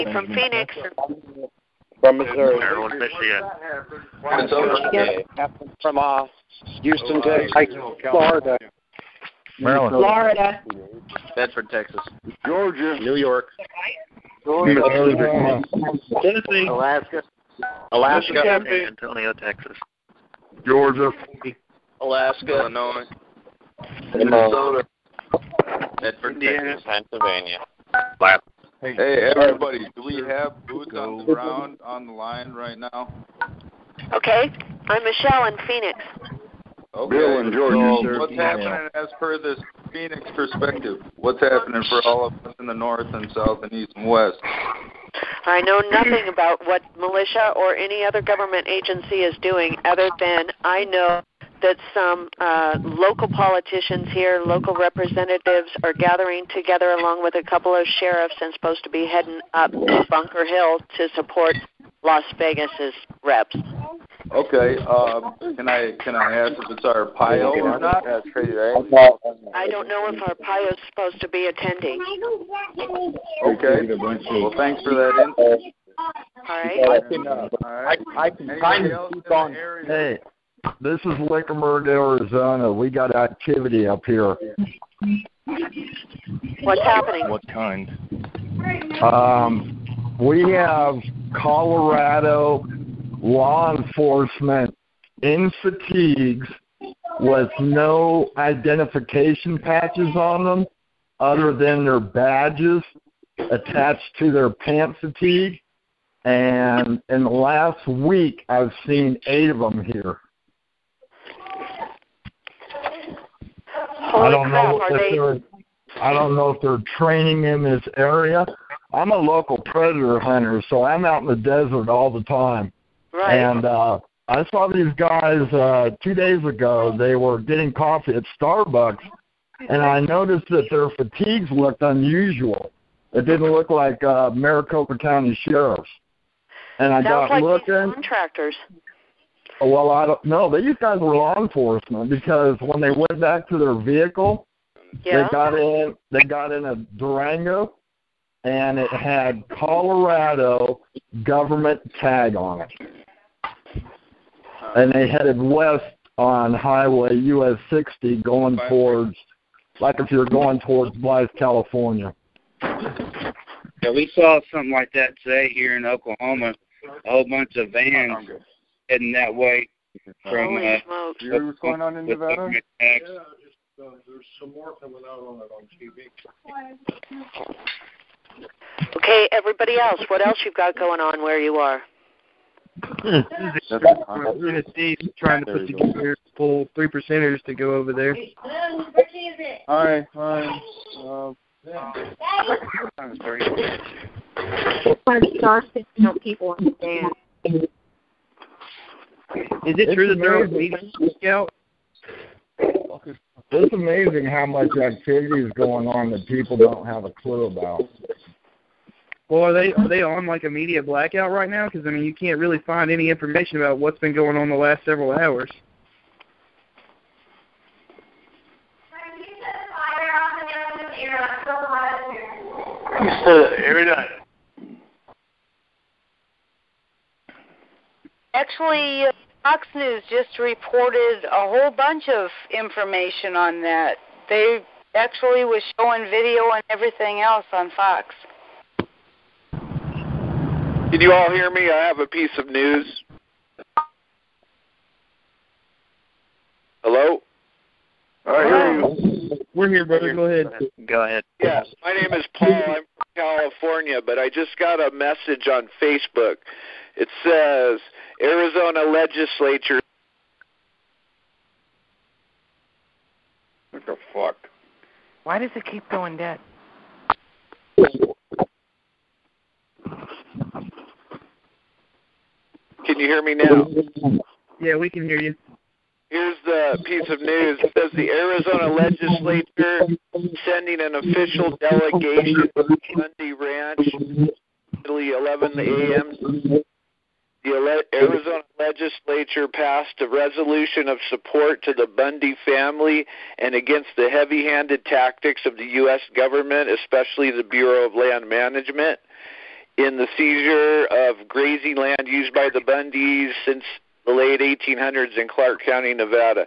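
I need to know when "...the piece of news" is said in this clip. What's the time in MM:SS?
04:36.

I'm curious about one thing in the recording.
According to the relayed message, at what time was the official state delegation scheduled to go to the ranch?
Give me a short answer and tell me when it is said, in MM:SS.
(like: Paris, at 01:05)
11 a.m., at 04:44.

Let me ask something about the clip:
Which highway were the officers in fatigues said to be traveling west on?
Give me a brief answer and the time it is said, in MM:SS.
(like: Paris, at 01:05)
US 60, at 02:37.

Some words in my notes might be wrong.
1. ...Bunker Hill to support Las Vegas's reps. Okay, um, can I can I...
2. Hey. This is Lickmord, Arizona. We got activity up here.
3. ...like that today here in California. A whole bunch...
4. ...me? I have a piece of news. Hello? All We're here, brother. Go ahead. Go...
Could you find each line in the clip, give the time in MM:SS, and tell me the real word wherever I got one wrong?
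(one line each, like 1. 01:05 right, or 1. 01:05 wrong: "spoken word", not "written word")
1. 01:00 right
2. 01:19 right
3. 02:44 wrong: "Oklahoma", not "California"
4. 04:01 right.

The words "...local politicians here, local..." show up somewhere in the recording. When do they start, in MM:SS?
00:52.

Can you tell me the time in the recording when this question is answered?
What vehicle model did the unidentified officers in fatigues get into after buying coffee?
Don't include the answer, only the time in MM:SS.
02:26.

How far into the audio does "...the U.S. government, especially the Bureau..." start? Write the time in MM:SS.
04:55.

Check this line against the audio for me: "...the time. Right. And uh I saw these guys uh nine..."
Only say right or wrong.
wrong.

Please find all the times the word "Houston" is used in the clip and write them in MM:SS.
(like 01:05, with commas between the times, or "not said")
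00:06.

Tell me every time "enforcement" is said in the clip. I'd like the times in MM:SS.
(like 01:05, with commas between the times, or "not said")
01:33, 02:21.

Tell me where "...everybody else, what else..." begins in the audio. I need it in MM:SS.
02:59.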